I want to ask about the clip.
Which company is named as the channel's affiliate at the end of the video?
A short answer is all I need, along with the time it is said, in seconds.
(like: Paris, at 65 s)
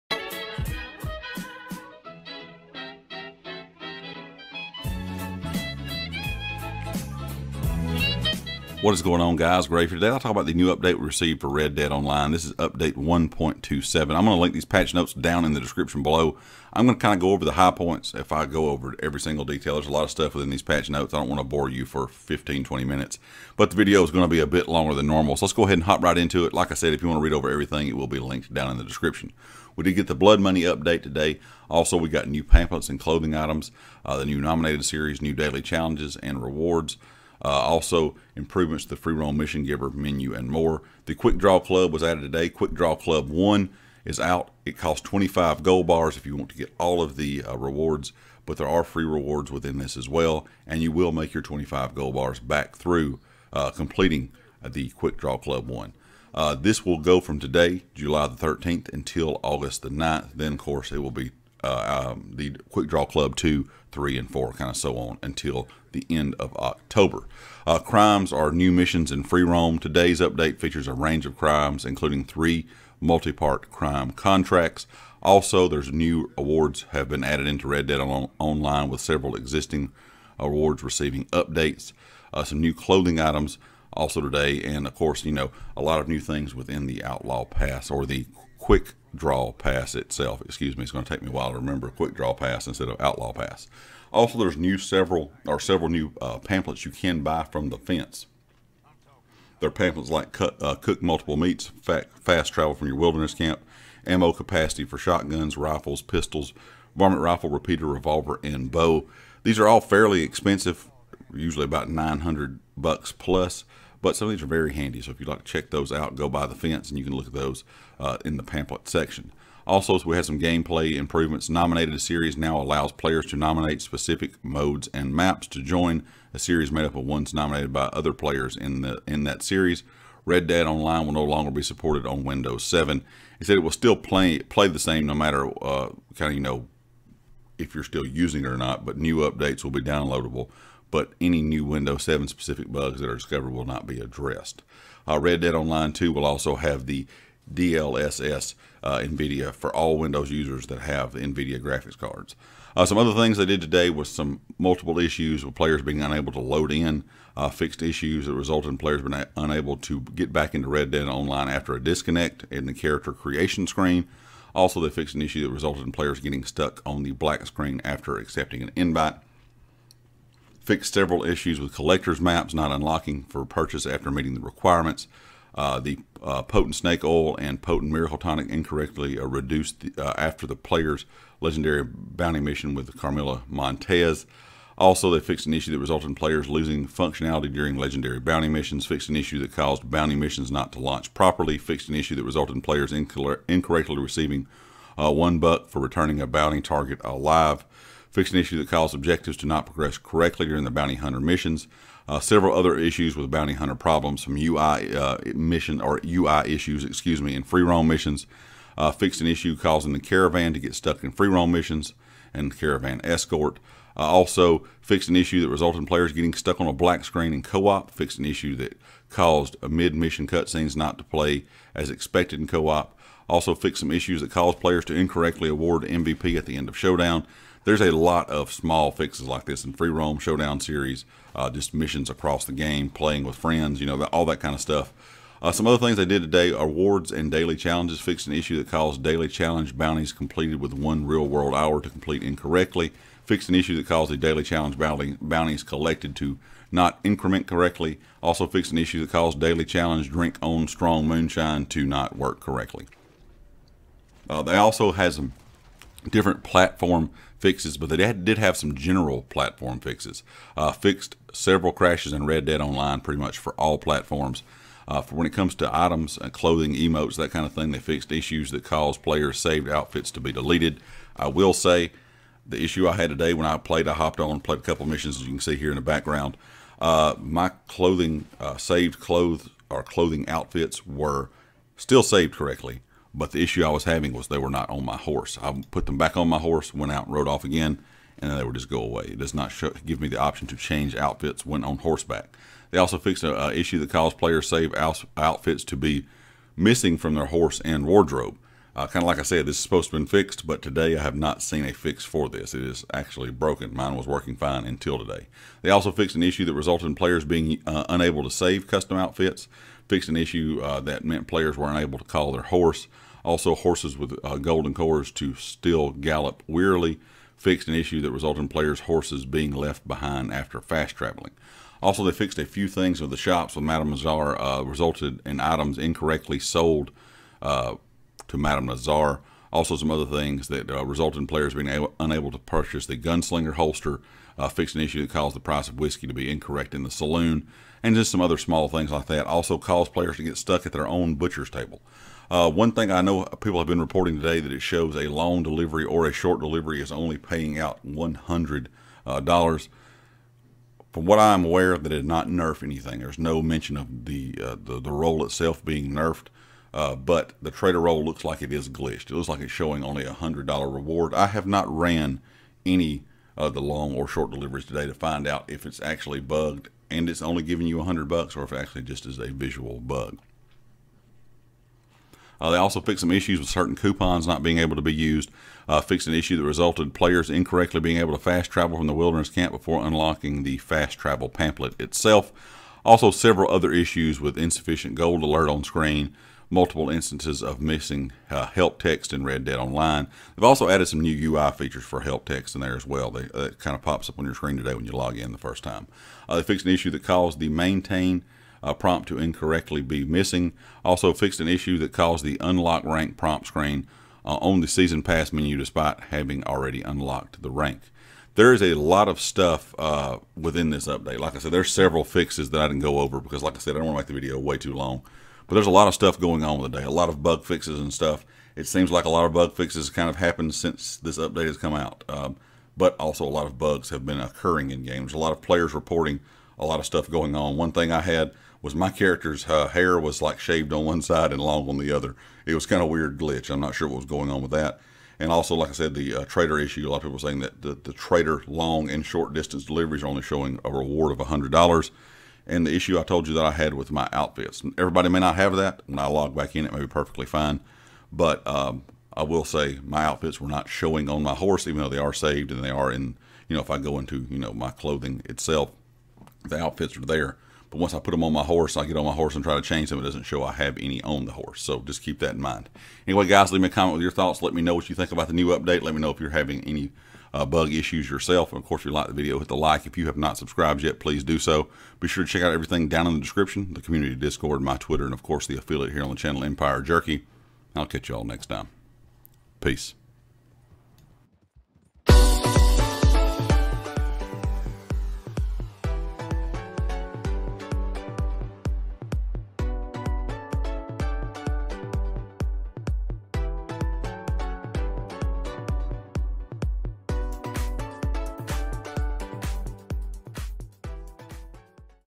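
Empire Jerky, at 476 s.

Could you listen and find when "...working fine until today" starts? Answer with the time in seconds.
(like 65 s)
304 s.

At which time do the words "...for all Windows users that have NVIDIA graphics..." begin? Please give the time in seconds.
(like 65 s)
149 s.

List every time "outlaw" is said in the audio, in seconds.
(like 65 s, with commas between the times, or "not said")
87 s, 92 s.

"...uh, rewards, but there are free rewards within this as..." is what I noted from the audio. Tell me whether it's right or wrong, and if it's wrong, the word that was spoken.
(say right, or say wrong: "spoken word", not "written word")
right.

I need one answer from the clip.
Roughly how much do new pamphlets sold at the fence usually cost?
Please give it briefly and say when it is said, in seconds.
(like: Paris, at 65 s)
$900, at 111 s.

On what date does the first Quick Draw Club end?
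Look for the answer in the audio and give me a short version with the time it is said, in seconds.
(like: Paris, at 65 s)
August 9, at 59 s.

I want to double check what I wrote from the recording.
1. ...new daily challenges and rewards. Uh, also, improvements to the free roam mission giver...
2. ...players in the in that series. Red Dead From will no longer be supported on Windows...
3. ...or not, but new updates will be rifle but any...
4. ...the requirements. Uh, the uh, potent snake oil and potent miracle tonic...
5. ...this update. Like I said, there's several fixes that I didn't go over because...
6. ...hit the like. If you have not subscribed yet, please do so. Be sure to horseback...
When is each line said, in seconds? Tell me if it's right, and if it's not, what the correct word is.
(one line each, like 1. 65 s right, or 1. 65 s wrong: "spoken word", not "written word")
1. 35 s right
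2. 128 s wrong: "Online", not "From"
3. 138 s wrong: "downloadable", not "rifle"
4. 174 s right
5. 410 s right
6. 469 s wrong: "check", not "horseback".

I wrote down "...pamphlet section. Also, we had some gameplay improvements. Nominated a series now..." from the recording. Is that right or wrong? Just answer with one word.
right.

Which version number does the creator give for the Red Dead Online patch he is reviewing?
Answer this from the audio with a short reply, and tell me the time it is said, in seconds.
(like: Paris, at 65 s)
1.27, at 12 s.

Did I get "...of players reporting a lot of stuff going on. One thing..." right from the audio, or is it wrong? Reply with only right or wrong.
right.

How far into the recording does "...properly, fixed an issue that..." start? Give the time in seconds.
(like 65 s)
191 s.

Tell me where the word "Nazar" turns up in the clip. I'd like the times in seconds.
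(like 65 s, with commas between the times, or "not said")
323 s, 328 s.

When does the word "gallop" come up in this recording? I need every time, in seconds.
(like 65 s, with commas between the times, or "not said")
315 s.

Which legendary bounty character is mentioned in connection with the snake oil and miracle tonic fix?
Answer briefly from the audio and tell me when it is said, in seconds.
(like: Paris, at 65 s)
Carmela Montez, at 182 s.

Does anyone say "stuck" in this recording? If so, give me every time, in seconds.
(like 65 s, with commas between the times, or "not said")
166 s, 210 s, 216 s, 340 s.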